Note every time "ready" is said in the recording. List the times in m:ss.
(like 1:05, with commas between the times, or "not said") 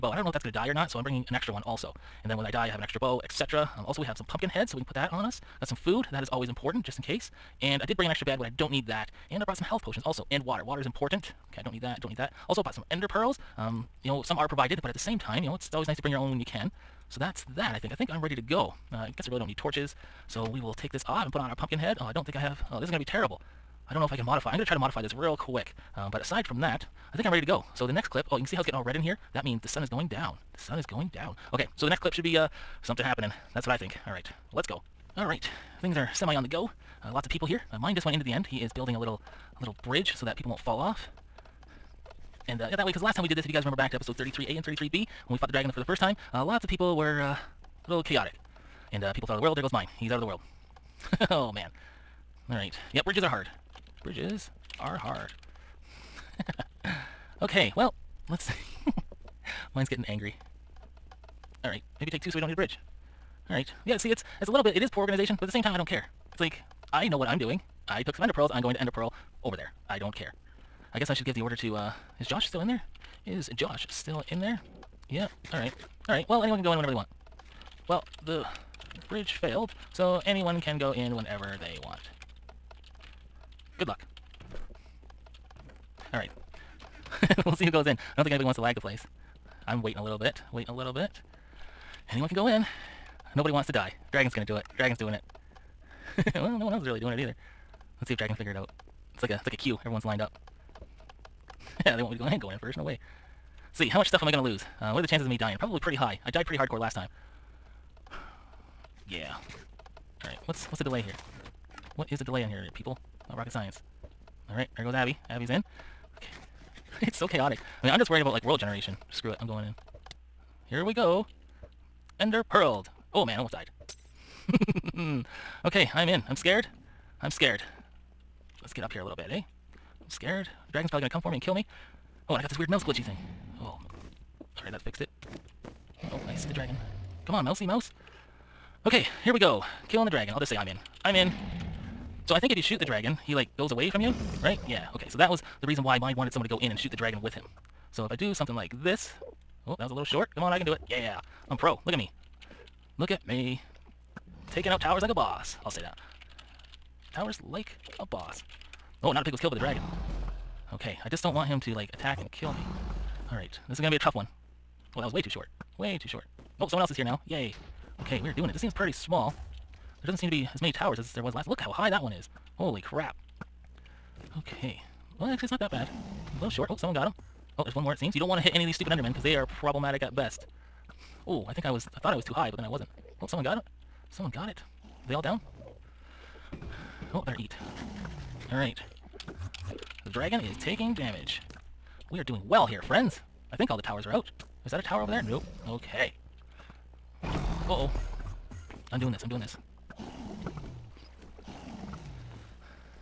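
0:18, 0:27.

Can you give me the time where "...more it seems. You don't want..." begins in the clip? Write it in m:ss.
2:57.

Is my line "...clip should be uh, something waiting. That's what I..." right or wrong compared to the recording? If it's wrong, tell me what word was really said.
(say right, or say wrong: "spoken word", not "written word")
wrong: "happening", not "waiting".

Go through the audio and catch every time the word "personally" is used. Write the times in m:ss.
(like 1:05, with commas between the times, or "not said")
not said.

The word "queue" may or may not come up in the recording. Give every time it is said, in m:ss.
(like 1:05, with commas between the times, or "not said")
1:39.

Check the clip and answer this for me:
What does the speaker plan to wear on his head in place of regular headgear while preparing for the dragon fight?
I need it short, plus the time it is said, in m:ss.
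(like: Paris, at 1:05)
pumpkin head, at 0:21.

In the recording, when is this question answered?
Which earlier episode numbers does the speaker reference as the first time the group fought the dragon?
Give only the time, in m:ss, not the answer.
0:44.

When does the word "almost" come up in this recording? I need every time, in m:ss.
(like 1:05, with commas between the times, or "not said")
2:03.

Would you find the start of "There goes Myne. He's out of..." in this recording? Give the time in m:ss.
0:49.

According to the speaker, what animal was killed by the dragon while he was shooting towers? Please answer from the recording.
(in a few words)
a pig.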